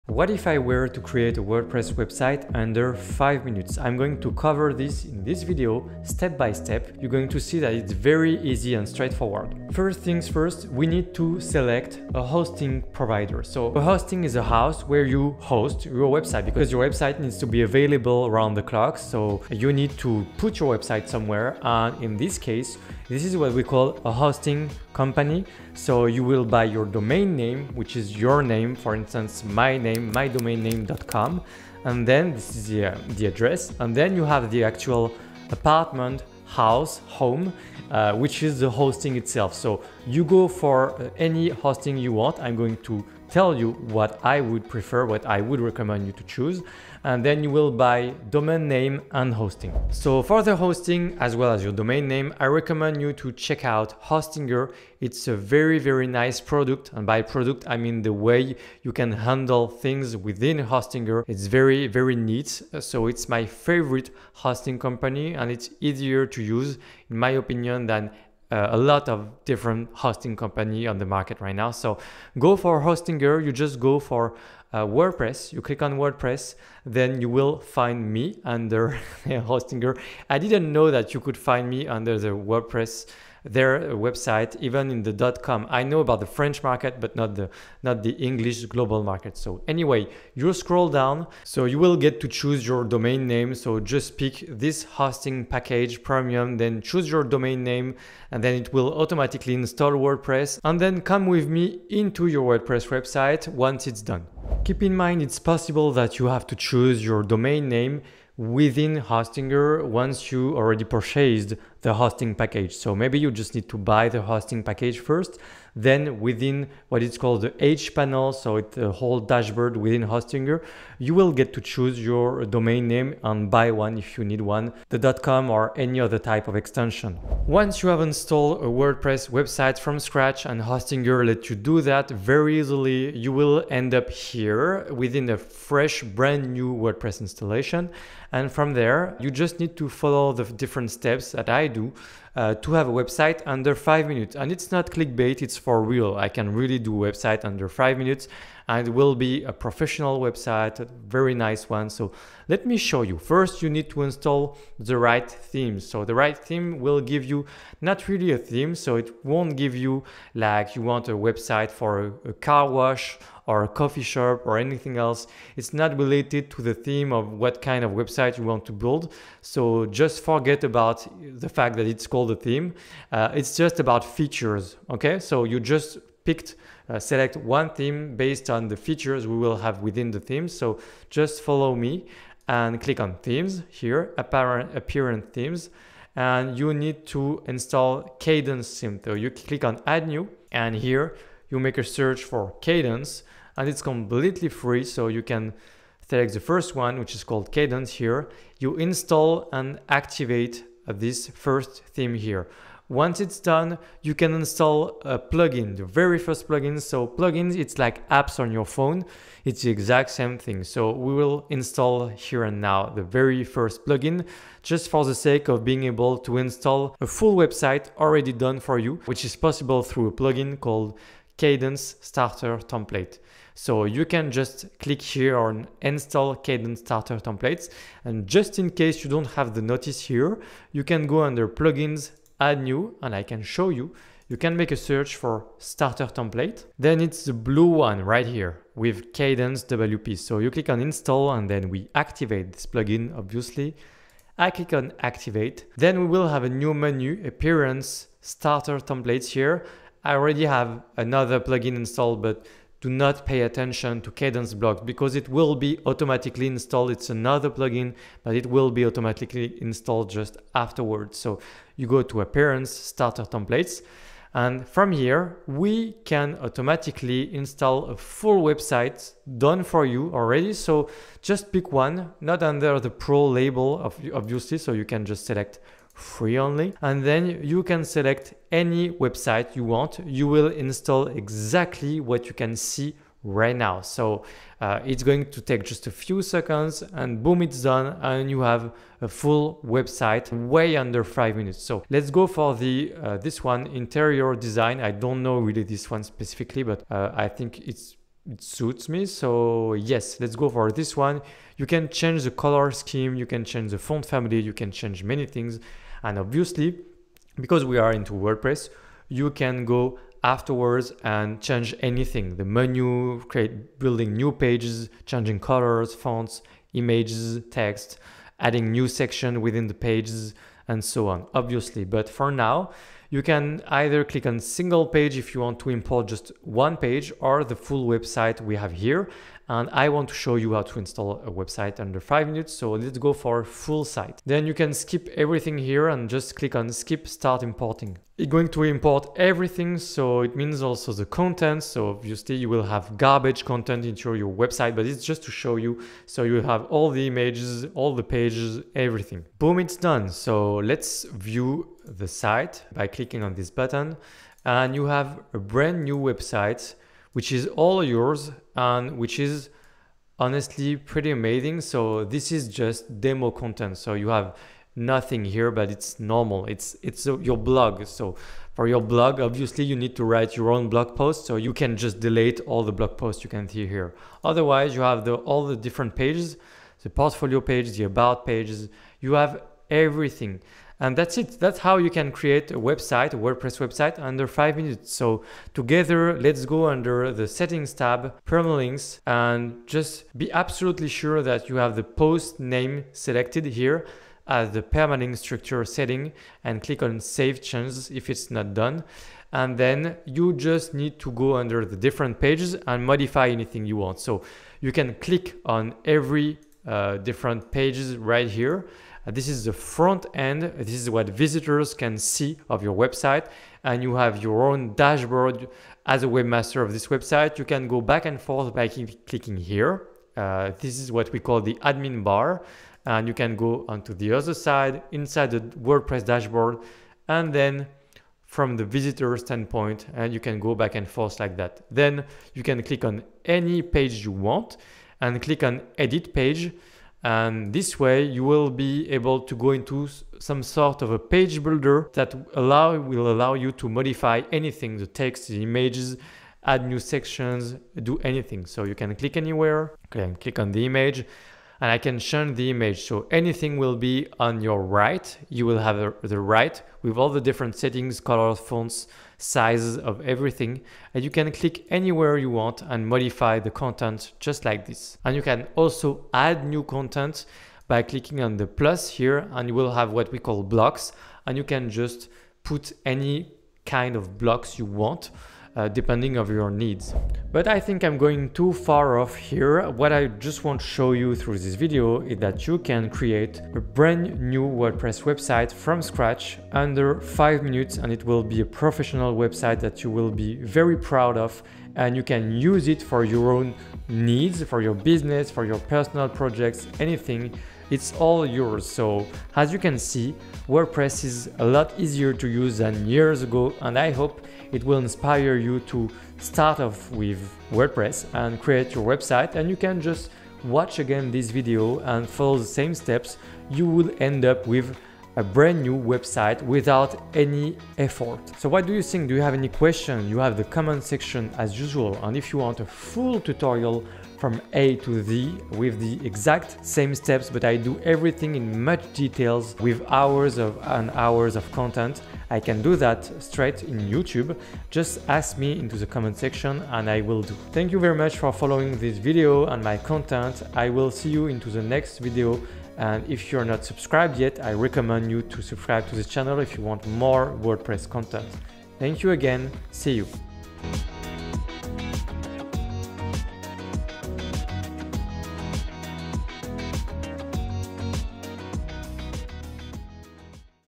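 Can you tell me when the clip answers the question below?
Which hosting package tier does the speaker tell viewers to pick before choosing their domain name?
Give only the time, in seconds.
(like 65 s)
96 s.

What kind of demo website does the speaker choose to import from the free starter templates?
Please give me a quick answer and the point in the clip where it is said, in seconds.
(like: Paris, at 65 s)
Interior design, at 293 s.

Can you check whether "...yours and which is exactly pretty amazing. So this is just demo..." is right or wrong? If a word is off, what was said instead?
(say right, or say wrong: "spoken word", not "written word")
wrong: "honestly", not "exactly".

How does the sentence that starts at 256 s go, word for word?
It's another plugin, but it will be automatically installed just afterwards.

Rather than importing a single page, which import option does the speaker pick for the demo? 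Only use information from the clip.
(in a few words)
Full site.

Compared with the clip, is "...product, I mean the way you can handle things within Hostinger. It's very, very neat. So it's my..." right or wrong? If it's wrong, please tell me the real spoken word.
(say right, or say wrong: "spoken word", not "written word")
right.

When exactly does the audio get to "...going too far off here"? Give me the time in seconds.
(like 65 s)
477 s.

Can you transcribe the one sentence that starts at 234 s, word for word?
You can make a search for starter template.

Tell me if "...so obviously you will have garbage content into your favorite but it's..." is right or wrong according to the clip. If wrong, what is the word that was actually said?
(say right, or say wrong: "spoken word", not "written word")
wrong: "website", not "favorite".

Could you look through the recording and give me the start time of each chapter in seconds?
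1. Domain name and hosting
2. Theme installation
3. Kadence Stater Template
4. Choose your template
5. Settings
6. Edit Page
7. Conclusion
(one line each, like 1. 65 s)
1. 50 s
2. 152 s
3. 210 s
4. 276 s
5. 385 s
6. 434 s
7. 480 s.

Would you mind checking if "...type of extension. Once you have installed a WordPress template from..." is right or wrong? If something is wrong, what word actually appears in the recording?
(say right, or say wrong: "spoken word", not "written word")
wrong: "website", not "template".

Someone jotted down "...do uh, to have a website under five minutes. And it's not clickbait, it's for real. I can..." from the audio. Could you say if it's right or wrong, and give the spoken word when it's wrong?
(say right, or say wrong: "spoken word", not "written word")
right.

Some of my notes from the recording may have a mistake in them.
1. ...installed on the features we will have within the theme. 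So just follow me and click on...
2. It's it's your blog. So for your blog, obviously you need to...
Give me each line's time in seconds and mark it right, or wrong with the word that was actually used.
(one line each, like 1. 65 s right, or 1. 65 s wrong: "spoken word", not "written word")
1. 178 s wrong: "based", not "installed"
2. 366 s right.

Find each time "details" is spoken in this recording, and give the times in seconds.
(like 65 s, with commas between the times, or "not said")
528 s.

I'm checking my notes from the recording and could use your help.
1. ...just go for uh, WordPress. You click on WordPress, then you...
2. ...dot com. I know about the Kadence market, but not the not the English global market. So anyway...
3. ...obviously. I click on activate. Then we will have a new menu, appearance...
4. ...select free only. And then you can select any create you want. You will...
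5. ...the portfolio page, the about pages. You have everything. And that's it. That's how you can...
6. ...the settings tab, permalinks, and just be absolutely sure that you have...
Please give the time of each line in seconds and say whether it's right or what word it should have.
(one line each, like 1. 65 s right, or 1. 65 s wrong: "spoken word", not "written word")
1. 73 s right
2. 85 s wrong: "French", not "Kadence"
3. 243 s right
4. 275 s wrong: "website", not "create"
5. 376 s right
6. 387 s right.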